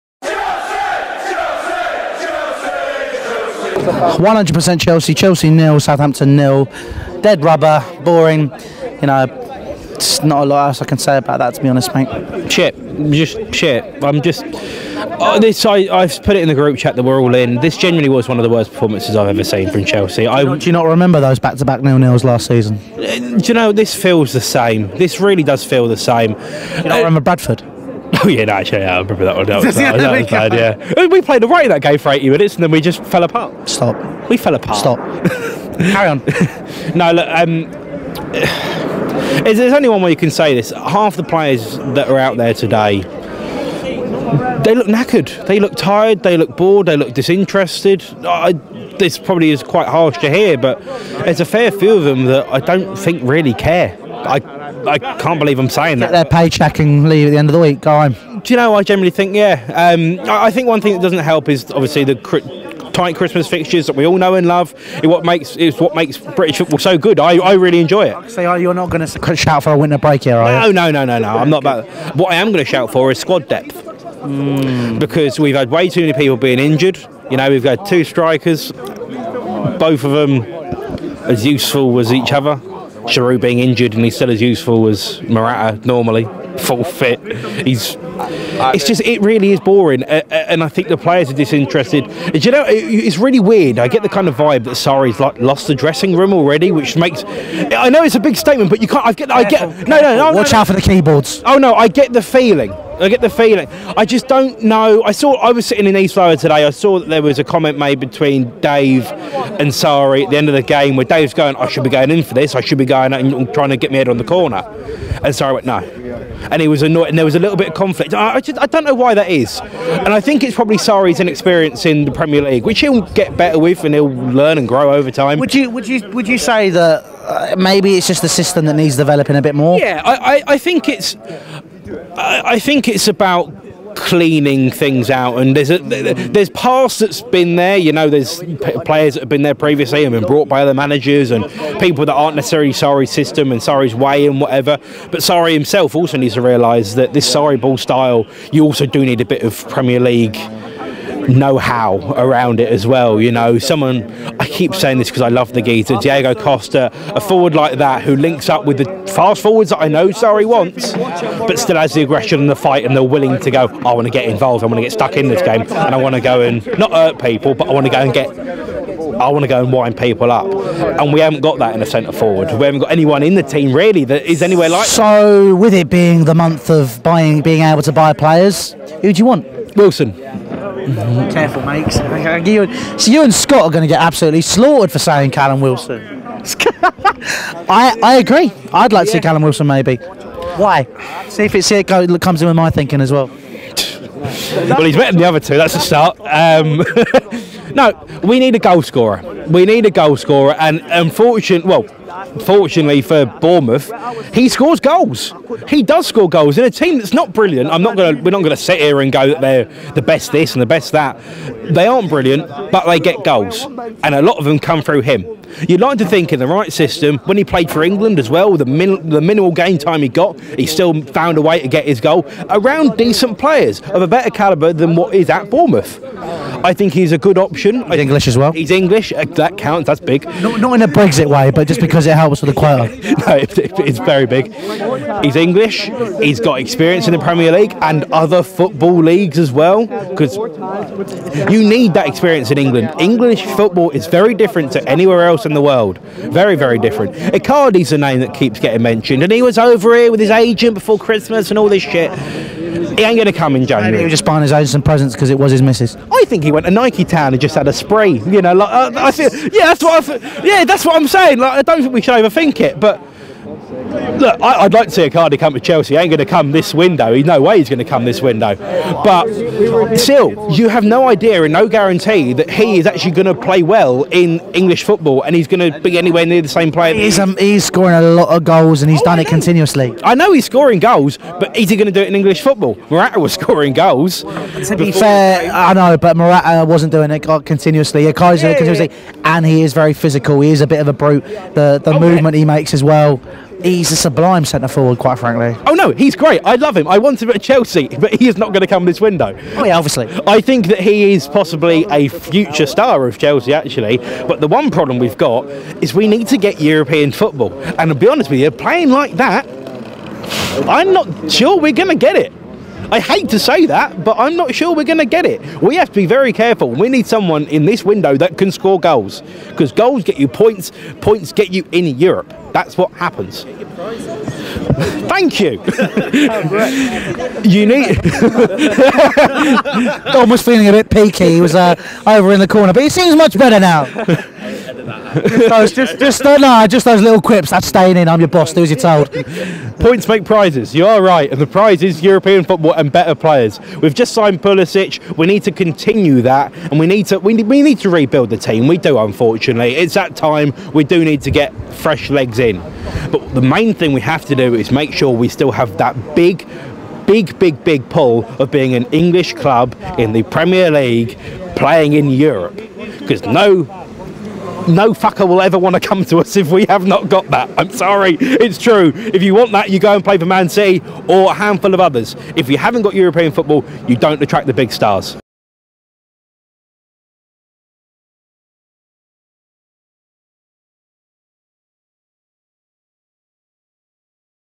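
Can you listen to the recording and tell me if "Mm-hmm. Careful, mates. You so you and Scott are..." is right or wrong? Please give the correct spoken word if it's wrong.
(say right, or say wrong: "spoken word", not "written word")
right.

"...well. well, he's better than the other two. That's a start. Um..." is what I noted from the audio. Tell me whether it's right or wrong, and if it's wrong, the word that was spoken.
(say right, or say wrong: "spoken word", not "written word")
right.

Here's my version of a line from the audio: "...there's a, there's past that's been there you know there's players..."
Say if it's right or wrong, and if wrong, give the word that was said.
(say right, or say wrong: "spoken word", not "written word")
right.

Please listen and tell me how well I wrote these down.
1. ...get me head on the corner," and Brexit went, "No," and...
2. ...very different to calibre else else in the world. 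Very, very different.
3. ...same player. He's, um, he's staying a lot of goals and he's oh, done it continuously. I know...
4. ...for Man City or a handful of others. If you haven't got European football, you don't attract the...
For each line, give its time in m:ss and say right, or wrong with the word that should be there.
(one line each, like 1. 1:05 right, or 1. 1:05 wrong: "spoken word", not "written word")
1. 1:53 wrong: "Sarri", not "Brexit"
2. 4:04 wrong: "anywhere", not "calibre"
3. 4:36 wrong: "scoring", not "staying"
4. 6:10 right.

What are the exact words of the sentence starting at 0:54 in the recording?
I I can't believe I'm saying that.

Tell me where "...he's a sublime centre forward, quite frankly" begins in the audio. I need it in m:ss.
4:53.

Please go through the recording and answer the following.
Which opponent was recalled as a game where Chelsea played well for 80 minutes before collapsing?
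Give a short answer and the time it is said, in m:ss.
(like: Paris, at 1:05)
Bradford, at 0:27.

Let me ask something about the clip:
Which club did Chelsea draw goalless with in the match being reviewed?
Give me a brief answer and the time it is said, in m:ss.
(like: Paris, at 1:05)
Southampton, at 0:05.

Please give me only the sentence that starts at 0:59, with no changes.
Um, I, think one thing that doesn't help is obviously the cri- tight Christmas fixtures that we all know and love.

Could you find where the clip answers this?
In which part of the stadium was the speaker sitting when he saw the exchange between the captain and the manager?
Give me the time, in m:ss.
1:45.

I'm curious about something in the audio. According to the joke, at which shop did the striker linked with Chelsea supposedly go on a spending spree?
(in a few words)
Nike Town.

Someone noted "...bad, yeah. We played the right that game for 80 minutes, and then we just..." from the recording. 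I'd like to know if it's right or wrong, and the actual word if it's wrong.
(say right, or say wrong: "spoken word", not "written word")
right.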